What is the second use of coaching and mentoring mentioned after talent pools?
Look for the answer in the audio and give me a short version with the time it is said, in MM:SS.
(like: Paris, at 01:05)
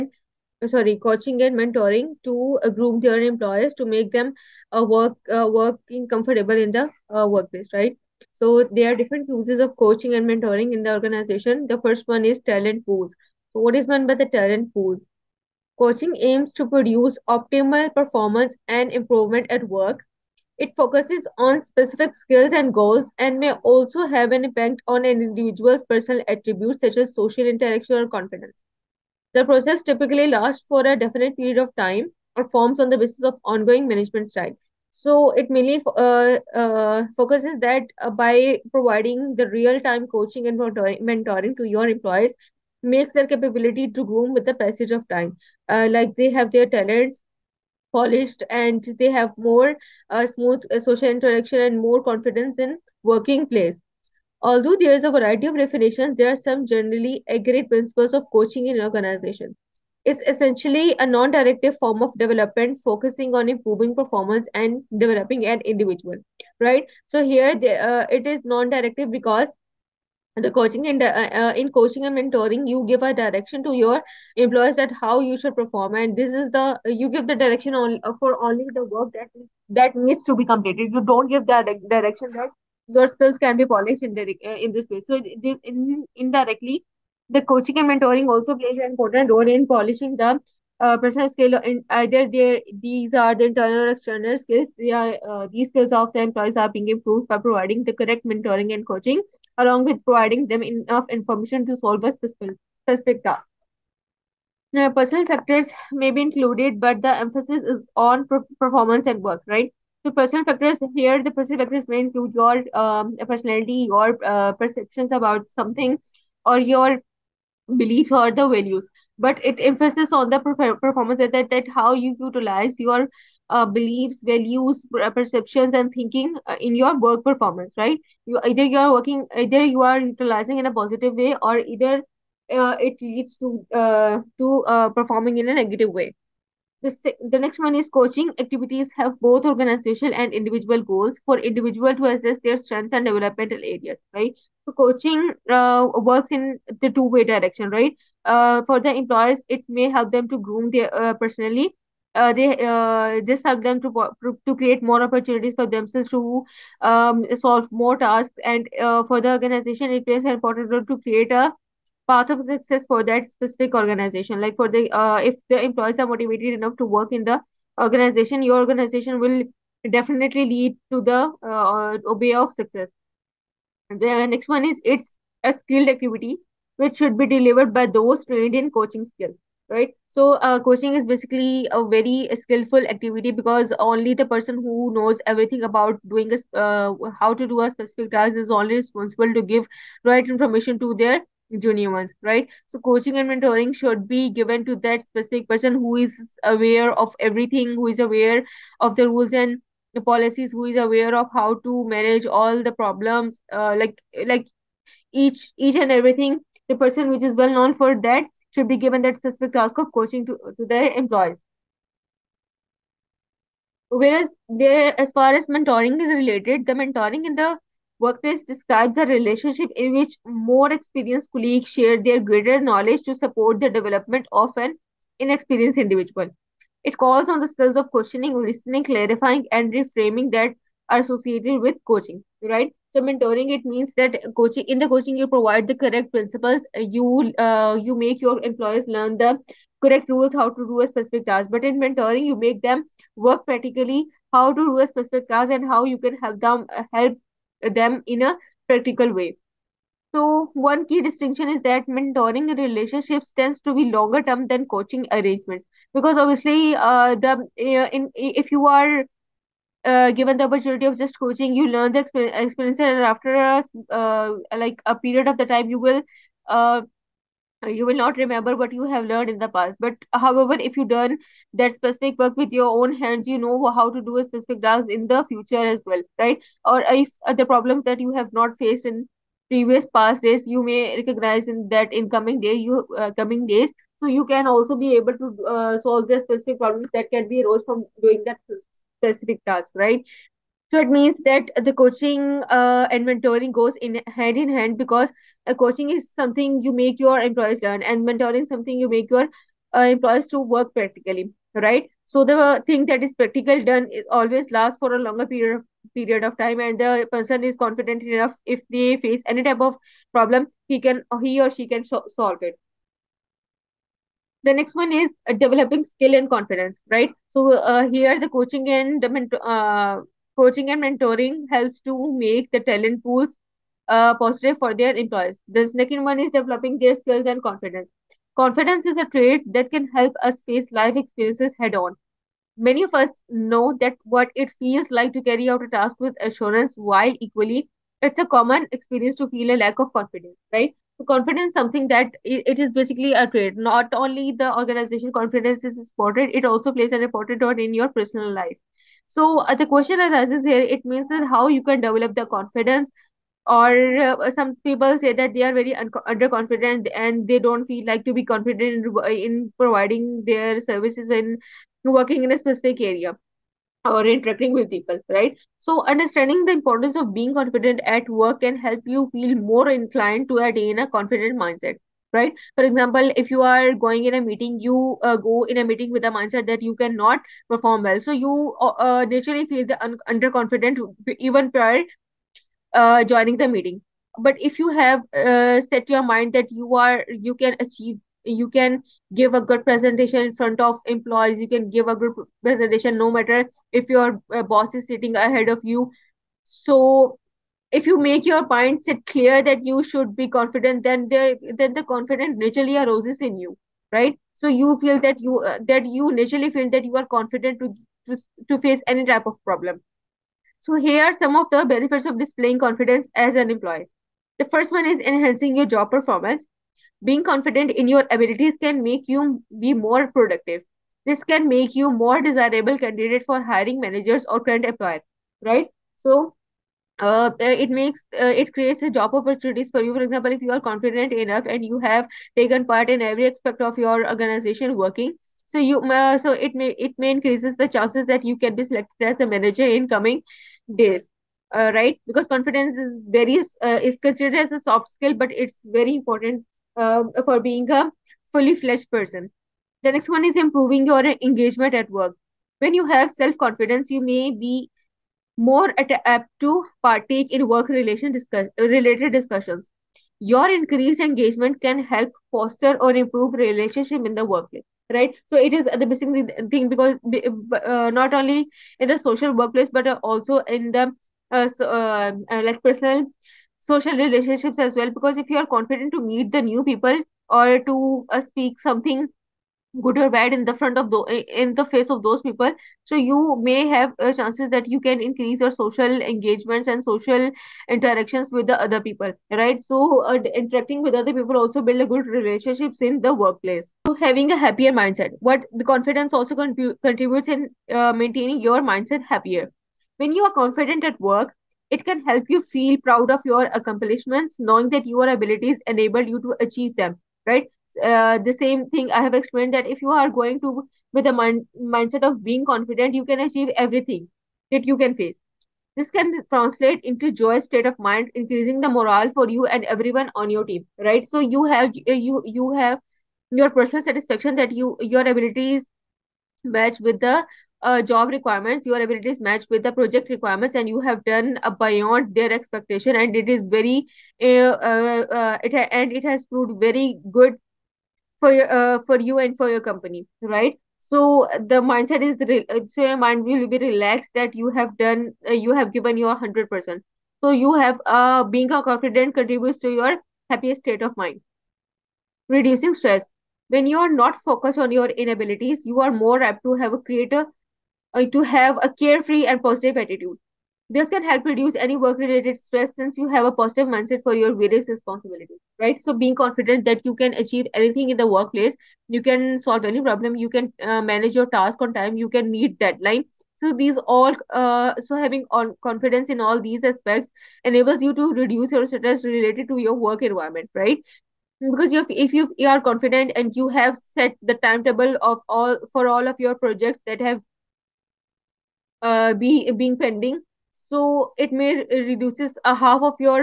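Developing skill and confidence, at 05:15.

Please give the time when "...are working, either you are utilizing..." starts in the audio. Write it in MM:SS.
02:08.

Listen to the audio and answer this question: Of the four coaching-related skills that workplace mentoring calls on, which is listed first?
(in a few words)
Questioning.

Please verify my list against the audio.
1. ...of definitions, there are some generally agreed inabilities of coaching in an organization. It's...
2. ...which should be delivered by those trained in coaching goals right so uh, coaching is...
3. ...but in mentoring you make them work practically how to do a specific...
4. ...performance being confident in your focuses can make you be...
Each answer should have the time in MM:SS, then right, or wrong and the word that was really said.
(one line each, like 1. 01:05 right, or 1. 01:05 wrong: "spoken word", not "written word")
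1. 00:55 wrong: "principles", not "inabilities"
2. 02:56 wrong: "skills", not "goals"
3. 04:01 right
4. 06:55 wrong: "abilities", not "focuses".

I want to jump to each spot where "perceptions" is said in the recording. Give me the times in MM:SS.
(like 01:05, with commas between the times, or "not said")
01:54, 02:05.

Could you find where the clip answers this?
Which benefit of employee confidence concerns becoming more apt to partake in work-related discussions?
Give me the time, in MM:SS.
07:30.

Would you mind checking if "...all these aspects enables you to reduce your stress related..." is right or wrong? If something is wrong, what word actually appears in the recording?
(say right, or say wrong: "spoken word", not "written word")
right.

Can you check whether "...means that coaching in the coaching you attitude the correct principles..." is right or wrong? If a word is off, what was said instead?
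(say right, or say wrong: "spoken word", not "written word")
wrong: "provide", not "attitude".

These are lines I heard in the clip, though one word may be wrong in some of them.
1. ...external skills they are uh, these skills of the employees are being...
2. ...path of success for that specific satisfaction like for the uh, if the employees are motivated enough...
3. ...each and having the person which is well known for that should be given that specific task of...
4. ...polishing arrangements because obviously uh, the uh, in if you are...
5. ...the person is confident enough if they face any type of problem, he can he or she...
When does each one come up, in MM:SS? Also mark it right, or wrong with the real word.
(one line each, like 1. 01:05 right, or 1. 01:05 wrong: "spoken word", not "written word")
1. 01:33 right
2. 02:42 wrong: "organization", not "satisfaction"
3. 03:25 wrong: "everything", not "having"
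4. 04:14 wrong: "coaching", not "polishing"
5. 05:06 right.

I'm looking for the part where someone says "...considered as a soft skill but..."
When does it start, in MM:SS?
07:24.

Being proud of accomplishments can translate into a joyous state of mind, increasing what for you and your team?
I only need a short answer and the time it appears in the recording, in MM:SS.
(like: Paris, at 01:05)
Morale, at 08:38.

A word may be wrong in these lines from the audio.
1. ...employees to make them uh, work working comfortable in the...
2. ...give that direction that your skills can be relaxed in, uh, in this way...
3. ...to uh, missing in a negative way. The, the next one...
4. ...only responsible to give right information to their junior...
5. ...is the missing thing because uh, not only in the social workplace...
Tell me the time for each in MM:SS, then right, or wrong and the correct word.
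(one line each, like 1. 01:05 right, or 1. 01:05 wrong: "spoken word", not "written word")
1. 00:03 right
2. 01:21 wrong: "polished", not "relaxed"
3. 02:14 wrong: "performing", not "missing"
4. 03:08 right
5. 07:45 right.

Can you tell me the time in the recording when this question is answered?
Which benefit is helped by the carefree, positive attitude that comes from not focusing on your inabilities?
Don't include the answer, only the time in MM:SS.
09:12.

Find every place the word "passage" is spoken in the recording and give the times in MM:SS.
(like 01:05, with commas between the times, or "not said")
00:44.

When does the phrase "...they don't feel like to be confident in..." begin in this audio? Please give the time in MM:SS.
05:57.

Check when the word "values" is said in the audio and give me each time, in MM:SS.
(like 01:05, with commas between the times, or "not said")
01:58, 02:04.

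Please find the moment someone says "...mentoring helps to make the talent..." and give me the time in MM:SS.
05:20.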